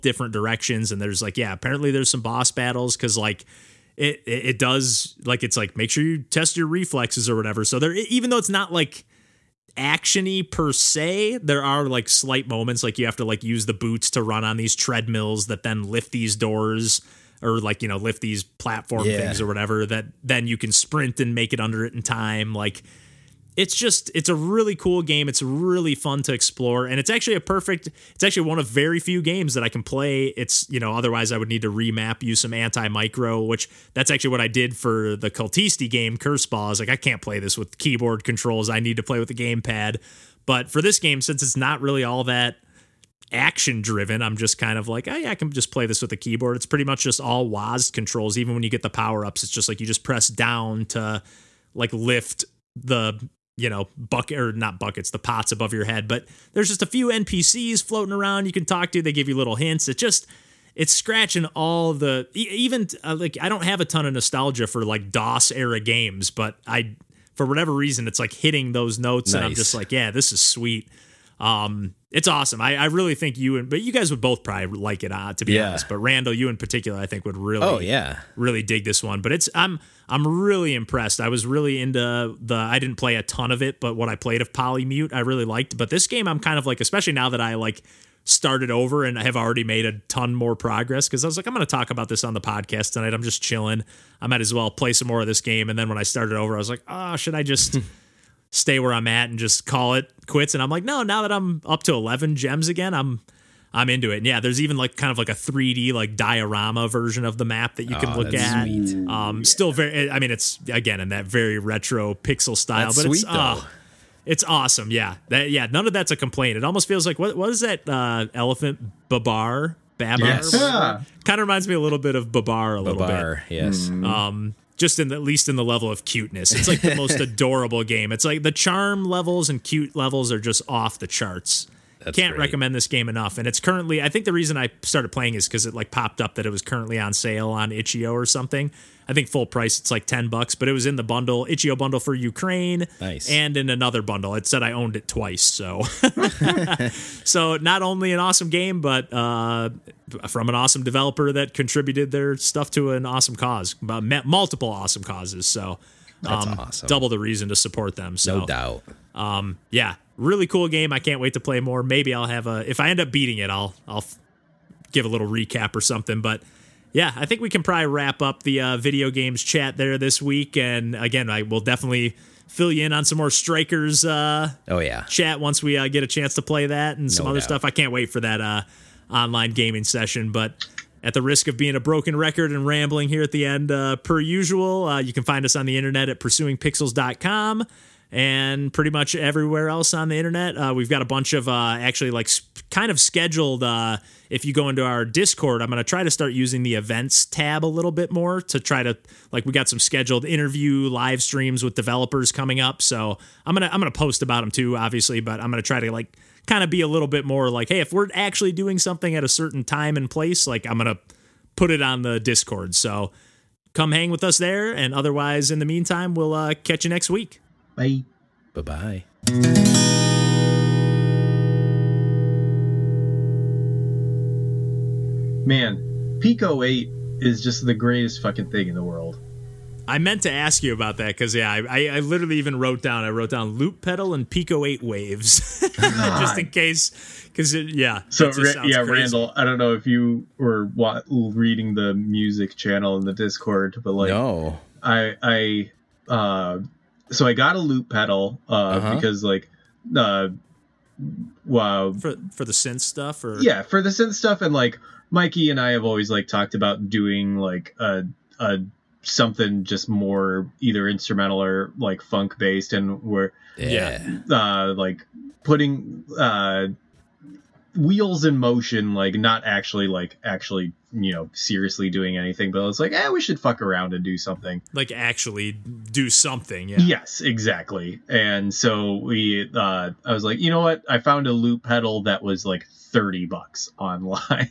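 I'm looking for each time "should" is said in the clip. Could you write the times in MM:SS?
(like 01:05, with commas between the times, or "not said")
01:37, 04:33.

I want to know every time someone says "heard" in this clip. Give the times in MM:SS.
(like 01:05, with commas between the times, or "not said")
not said.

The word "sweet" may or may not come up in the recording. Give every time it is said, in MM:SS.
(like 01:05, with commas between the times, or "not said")
01:10, 01:48, 01:53.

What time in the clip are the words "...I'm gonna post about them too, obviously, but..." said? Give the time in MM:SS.
03:23.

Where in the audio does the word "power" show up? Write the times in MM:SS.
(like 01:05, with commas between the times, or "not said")
00:48.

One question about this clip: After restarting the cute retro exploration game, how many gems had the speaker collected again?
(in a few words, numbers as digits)
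11.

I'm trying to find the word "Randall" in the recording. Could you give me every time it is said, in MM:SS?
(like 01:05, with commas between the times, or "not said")
01:15, 03:58.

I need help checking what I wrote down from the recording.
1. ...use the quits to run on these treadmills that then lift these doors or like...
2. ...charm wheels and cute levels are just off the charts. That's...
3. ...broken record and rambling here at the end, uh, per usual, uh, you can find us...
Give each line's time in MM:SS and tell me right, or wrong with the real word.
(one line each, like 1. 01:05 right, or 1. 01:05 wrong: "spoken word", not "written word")
1. 00:13 wrong: "boots", not "quits"
2. 02:08 wrong: "levels", not "wheels"
3. 03:01 right.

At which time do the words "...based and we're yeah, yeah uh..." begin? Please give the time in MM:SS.
04:22.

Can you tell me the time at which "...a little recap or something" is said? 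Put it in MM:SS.
02:45.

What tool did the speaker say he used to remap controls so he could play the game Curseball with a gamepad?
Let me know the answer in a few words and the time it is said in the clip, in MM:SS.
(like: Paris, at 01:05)
AntiMicro, at 00:32.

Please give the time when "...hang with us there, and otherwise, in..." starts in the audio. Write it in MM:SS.
03:33.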